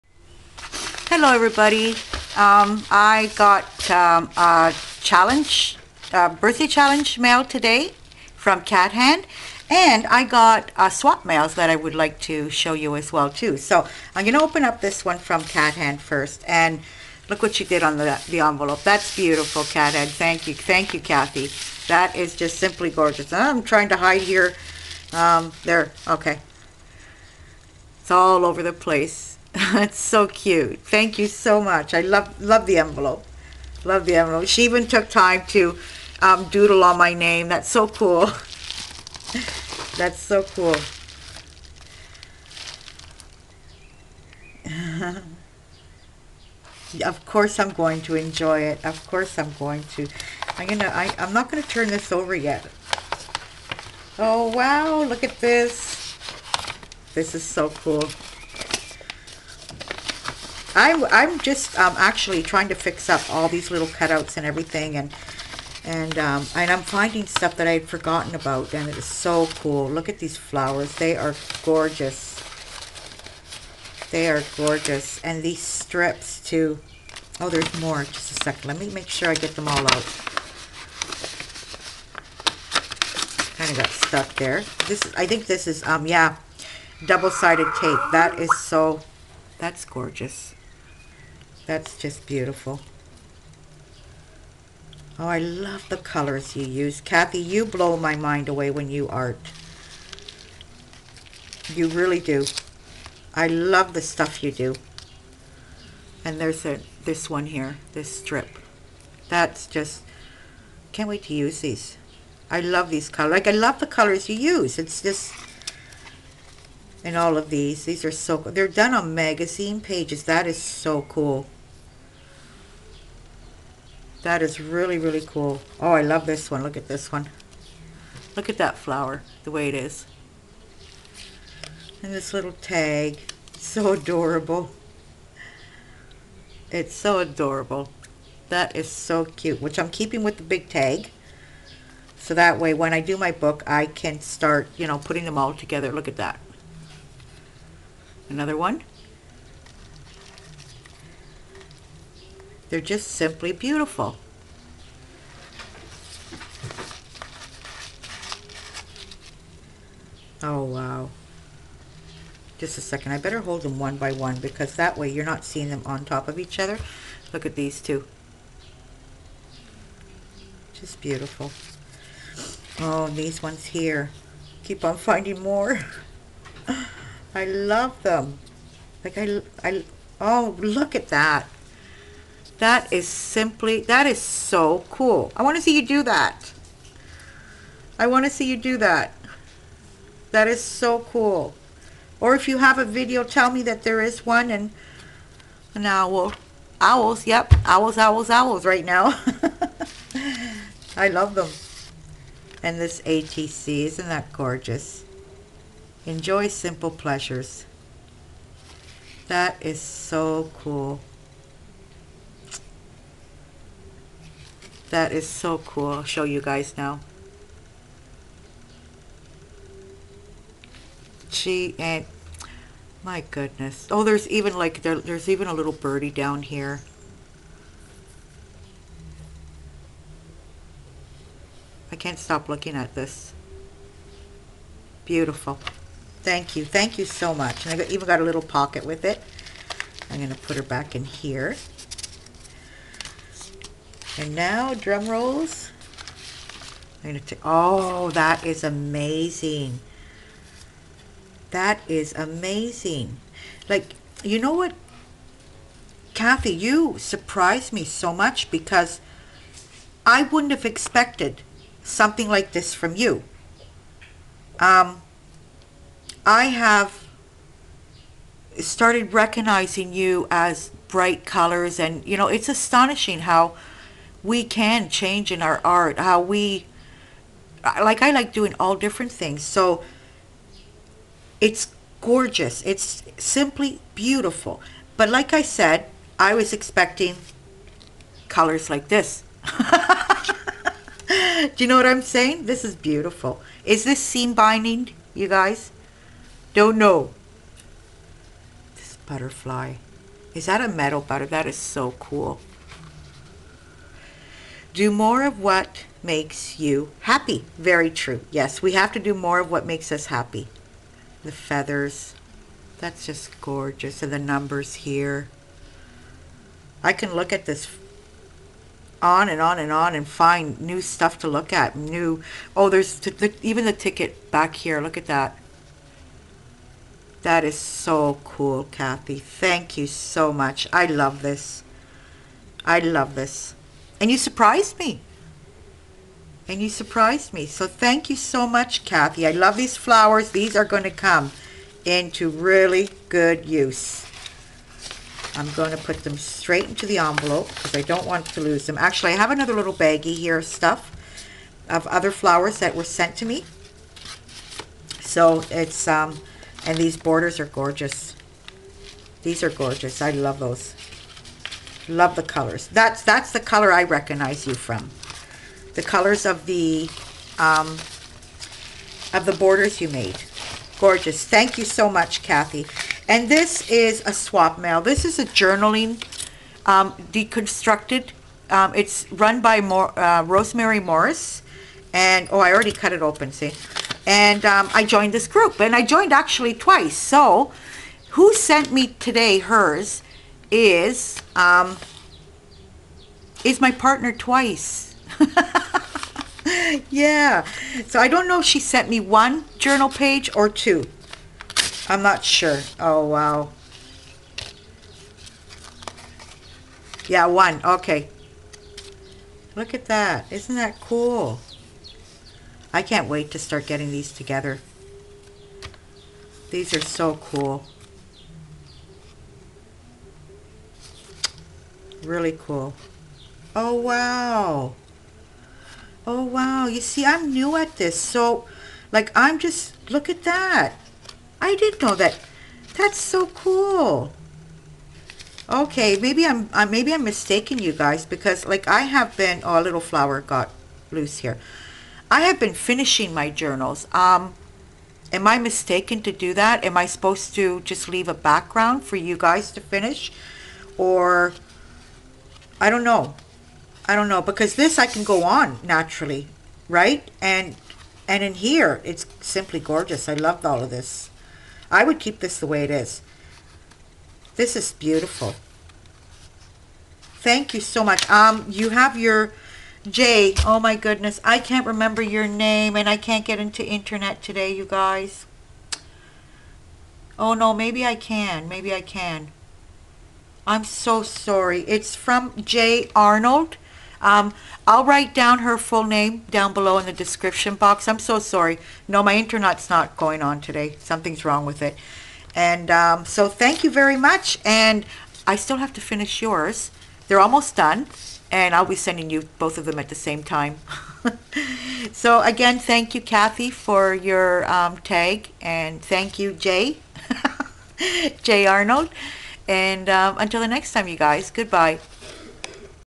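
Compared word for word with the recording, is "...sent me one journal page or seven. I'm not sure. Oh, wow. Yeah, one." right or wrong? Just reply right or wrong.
wrong.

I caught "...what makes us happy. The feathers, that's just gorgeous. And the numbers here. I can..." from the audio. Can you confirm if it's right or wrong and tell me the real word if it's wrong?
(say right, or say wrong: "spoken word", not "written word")
right.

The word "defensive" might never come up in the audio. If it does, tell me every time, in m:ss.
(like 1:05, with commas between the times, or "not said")
not said.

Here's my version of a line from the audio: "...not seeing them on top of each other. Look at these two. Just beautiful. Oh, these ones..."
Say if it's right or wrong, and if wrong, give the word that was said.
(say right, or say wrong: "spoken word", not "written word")
right.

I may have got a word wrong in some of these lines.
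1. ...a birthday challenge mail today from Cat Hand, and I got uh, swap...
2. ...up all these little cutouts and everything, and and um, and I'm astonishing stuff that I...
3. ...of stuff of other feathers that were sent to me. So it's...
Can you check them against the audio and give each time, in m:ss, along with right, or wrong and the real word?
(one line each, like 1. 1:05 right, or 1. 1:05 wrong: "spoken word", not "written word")
1. 0:06 right
2. 1:03 wrong: "finding", not "astonishing"
3. 5:50 wrong: "flowers", not "feathers".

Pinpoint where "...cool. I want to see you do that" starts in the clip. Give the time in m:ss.
3:04.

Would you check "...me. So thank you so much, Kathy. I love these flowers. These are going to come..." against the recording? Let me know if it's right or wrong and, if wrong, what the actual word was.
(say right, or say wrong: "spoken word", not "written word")
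right.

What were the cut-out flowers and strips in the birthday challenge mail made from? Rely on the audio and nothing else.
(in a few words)
magazine pages.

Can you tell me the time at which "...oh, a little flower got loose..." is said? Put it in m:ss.
7:19.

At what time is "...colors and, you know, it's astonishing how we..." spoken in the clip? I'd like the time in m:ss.
4:31.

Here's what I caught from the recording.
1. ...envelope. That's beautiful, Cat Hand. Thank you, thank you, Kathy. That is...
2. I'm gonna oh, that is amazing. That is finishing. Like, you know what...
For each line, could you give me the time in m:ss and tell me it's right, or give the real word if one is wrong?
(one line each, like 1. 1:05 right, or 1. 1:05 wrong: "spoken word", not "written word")
1. 0:18 right
2. 4:07 wrong: "amazing", not "finishing".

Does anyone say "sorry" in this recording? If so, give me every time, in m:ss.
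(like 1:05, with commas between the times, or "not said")
8:01, 8:08.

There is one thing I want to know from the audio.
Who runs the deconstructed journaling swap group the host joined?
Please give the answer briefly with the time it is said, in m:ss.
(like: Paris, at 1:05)
Rosemary Morris, at 6:20.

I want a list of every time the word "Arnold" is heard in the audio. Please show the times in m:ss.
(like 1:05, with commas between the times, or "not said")
8:02, 8:28.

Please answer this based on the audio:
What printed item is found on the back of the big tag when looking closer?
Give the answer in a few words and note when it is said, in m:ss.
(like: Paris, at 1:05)
ticket, at 5:23.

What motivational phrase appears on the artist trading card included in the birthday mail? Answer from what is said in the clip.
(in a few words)
Enjoy simple pleasures.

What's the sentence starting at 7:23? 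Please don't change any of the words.
Um, am I mistaken to do that?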